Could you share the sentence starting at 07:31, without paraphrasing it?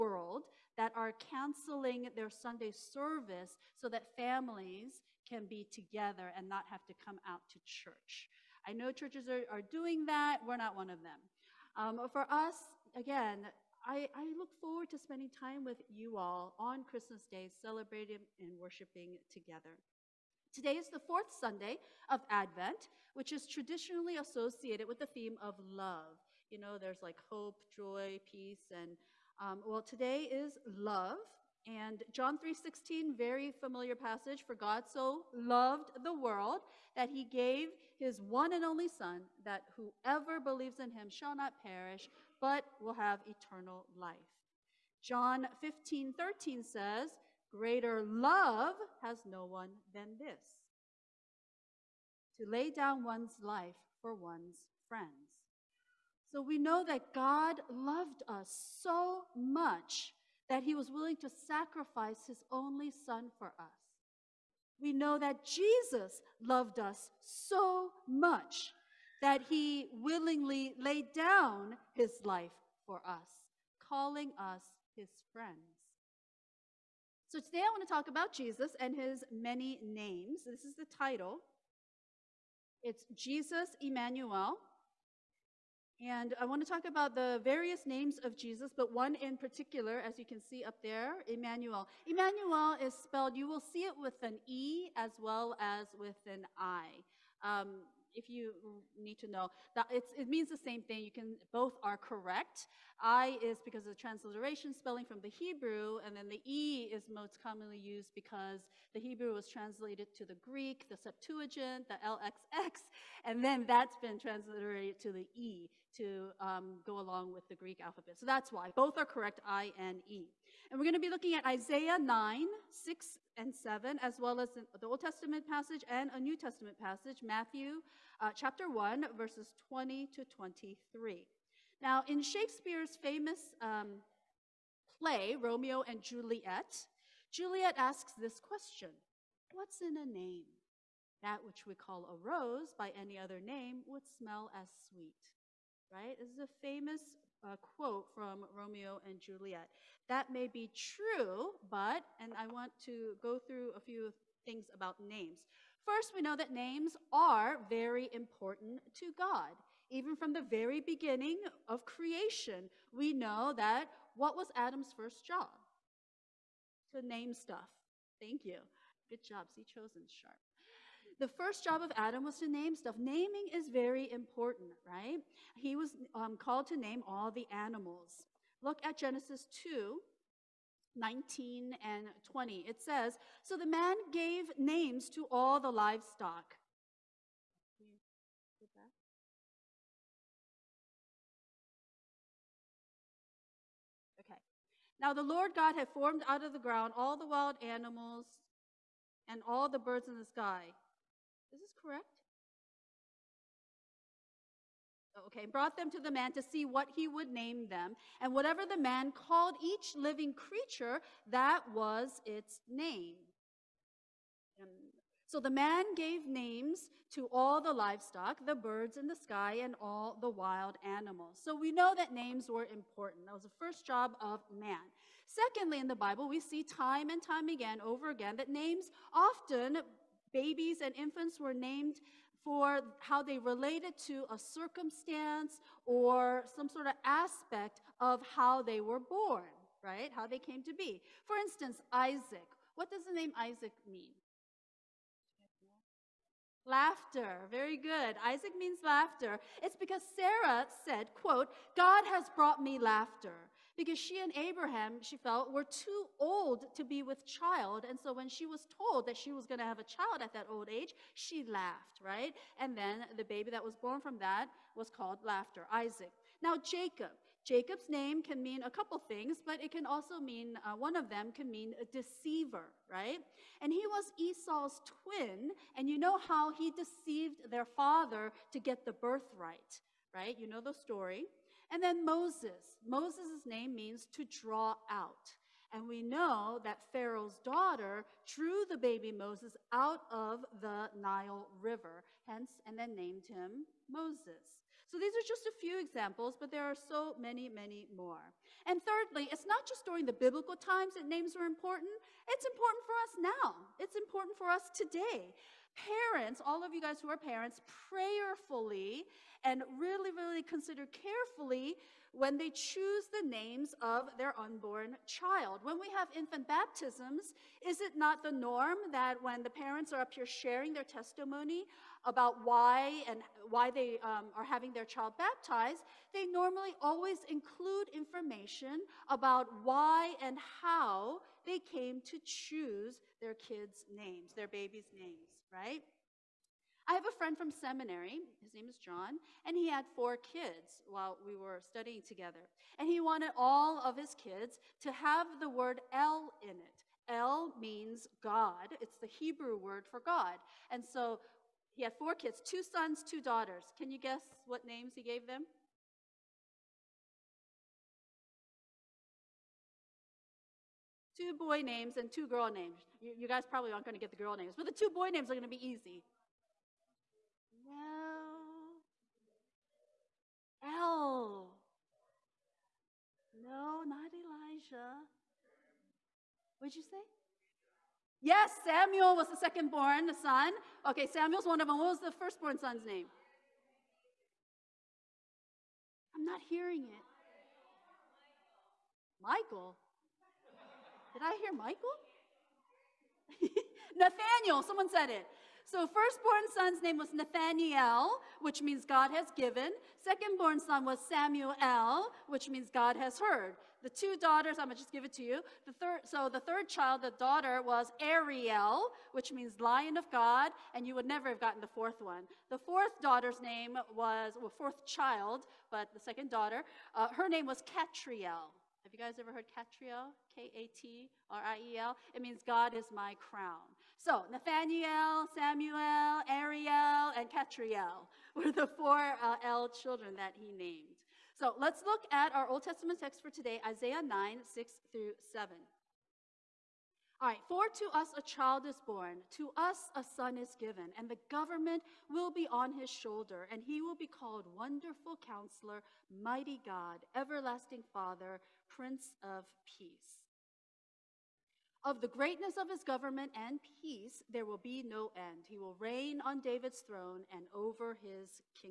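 Of the greatness of his government and peace, there will be no end.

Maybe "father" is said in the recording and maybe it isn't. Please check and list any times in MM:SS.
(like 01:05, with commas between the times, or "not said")
04:37, 07:27.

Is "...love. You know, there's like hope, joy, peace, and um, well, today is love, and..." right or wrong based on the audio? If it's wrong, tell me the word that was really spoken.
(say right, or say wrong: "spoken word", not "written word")
right.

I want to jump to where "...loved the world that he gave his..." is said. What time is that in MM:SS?
00:35.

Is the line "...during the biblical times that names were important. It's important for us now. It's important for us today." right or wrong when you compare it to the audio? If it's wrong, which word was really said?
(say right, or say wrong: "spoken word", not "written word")
right.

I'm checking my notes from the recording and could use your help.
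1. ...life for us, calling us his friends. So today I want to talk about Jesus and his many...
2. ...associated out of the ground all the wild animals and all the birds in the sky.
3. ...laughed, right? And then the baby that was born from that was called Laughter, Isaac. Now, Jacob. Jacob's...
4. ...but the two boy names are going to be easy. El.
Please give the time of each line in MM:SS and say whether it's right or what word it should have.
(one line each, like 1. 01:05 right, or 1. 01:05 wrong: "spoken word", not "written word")
1. 01:12 right
2. 03:15 wrong: "formed", not "associated"
3. 04:21 right
4. 06:04 right.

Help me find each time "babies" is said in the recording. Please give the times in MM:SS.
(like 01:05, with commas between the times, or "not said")
03:50, 05:34.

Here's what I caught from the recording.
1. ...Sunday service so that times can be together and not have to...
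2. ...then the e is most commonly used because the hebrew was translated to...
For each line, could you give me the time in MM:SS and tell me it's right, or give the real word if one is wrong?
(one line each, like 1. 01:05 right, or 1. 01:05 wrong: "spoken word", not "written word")
1. 00:02 wrong: "families", not "times"
2. 01:46 right.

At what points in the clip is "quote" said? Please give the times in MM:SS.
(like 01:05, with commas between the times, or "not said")
02:27, 04:11.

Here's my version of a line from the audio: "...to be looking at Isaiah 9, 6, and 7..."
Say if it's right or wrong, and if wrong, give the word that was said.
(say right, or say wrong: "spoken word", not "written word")
right.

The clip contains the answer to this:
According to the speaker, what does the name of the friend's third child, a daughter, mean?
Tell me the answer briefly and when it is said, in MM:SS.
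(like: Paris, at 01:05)
Lion of God, at 06:49.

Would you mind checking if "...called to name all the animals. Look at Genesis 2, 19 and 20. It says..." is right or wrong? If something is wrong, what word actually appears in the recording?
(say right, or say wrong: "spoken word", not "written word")
right.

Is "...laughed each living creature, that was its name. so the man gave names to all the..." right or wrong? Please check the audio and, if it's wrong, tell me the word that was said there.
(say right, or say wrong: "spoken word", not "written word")
wrong: "called", not "laughed".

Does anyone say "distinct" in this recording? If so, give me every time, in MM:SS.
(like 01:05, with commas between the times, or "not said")
not said.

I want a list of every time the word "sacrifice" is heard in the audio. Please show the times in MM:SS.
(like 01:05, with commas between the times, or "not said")
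01:01.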